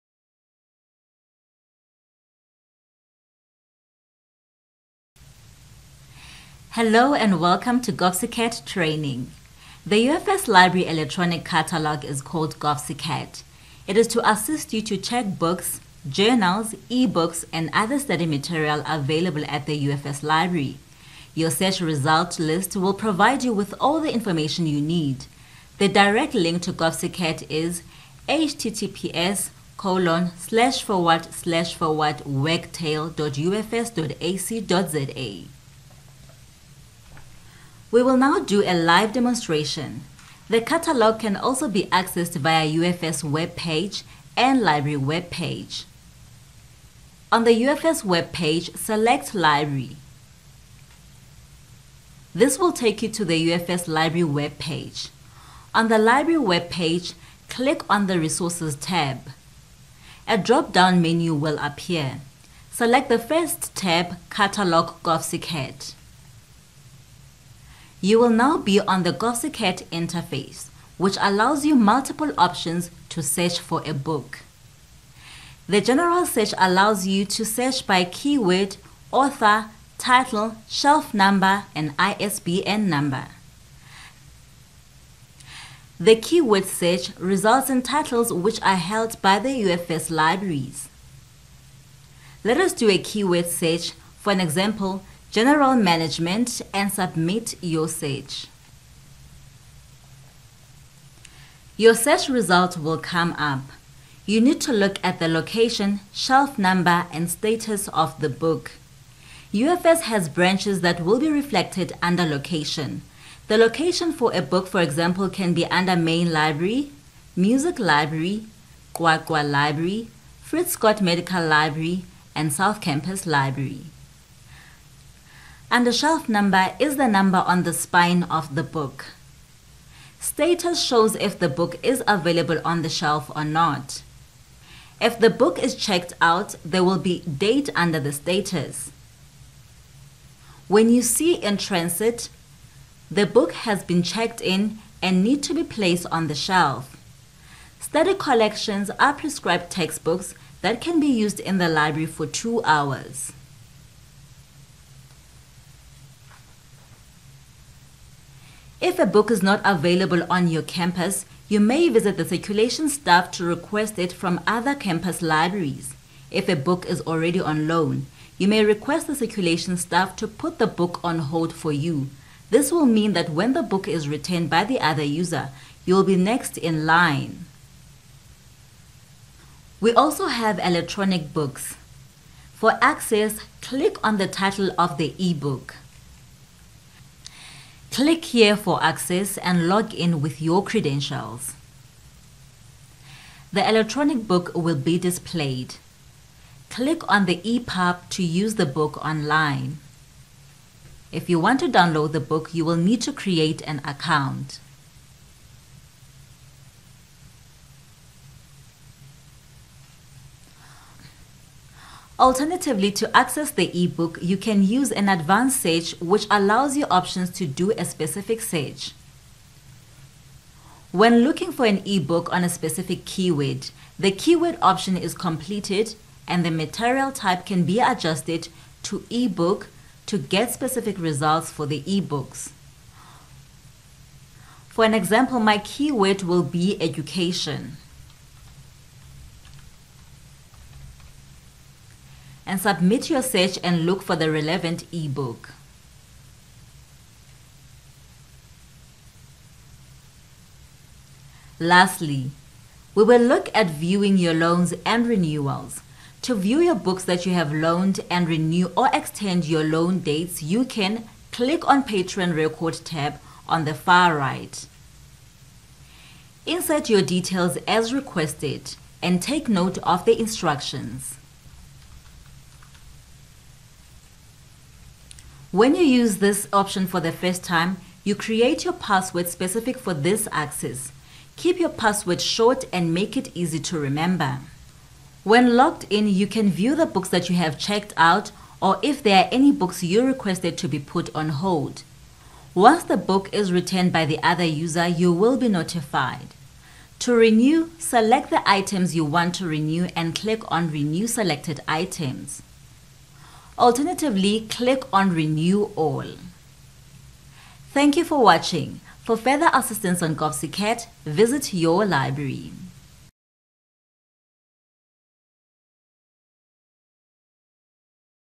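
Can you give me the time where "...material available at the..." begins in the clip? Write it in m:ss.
0:18.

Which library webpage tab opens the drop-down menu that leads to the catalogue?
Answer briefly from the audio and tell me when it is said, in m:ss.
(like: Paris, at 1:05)
resources, at 0:58.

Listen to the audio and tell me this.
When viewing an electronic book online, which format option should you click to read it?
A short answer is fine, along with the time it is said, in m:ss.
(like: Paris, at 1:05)
EPUB, at 3:17.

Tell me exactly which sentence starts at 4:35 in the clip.
When you use this option for the first time, you create your password specific for this access.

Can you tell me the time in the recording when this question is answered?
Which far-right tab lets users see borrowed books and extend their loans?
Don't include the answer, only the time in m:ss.
4:21.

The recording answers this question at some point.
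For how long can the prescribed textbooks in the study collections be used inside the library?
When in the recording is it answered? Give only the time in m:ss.
2:32.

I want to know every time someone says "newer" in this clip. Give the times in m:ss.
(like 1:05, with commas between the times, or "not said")
not said.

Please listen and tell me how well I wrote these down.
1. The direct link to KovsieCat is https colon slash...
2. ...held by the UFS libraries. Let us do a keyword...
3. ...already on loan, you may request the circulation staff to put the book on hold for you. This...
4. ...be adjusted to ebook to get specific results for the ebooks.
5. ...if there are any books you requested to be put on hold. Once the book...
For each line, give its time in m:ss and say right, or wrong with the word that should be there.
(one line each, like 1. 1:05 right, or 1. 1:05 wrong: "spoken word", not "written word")
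1. 0:25 right
2. 1:28 right
3. 2:47 right
4. 3:47 right
5. 4:48 right.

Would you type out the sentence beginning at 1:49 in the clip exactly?
UFS has branches that will be reflected under location.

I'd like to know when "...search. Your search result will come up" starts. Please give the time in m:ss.
1:37.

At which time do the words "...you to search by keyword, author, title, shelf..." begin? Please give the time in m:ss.
1:17.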